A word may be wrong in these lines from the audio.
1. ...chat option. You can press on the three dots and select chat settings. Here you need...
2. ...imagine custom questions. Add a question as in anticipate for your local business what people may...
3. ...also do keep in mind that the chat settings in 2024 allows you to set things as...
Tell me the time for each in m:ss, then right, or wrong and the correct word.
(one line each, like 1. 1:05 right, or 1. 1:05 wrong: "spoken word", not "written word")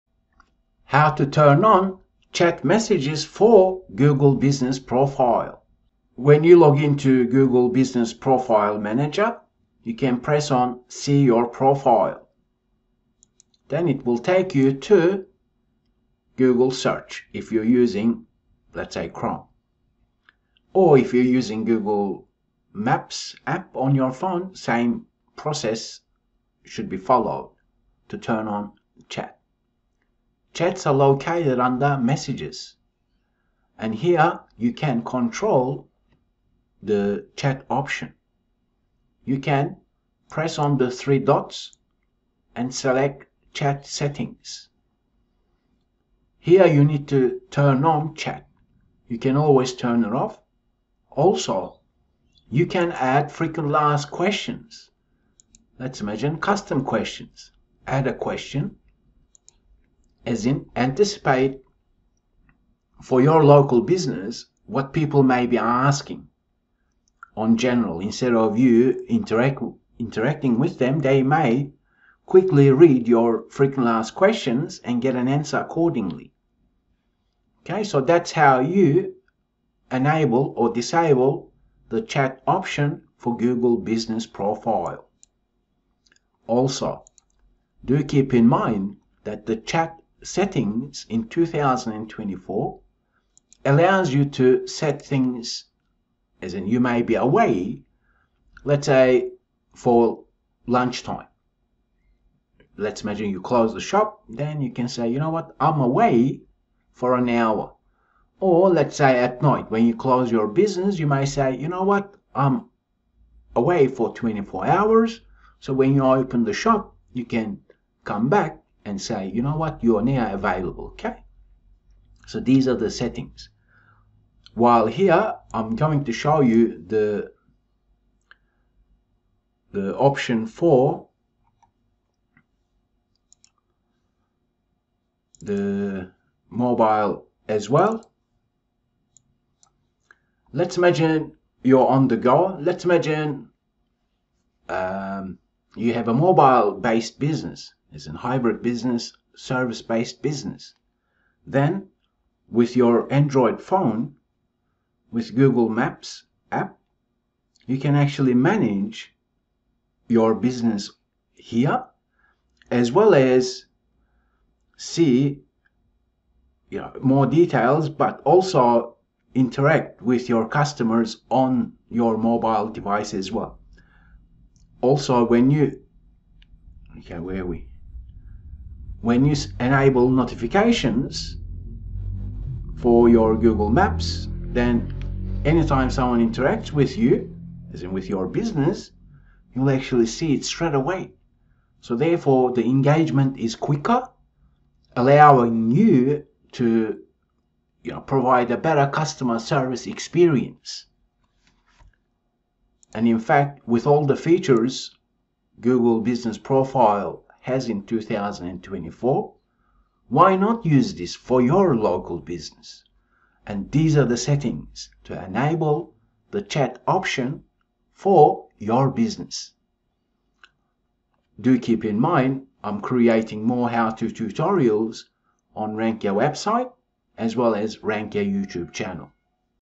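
1. 0:37 right
2. 0:56 right
3. 1:26 right.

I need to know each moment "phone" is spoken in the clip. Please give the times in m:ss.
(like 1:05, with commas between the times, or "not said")
0:24, 2:33.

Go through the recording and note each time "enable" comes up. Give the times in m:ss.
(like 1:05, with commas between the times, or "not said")
1:19, 2:59, 3:35.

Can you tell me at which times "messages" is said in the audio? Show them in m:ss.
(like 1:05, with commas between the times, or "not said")
0:02, 0:31.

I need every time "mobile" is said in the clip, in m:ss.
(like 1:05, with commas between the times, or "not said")
2:16, 2:26, 2:52.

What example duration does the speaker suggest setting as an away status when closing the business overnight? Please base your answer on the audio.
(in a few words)
24 hours.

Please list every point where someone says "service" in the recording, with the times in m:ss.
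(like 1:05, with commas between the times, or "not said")
2:29, 3:19.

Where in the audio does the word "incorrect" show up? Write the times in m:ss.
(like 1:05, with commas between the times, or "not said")
not said.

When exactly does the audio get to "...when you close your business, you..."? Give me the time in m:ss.
1:49.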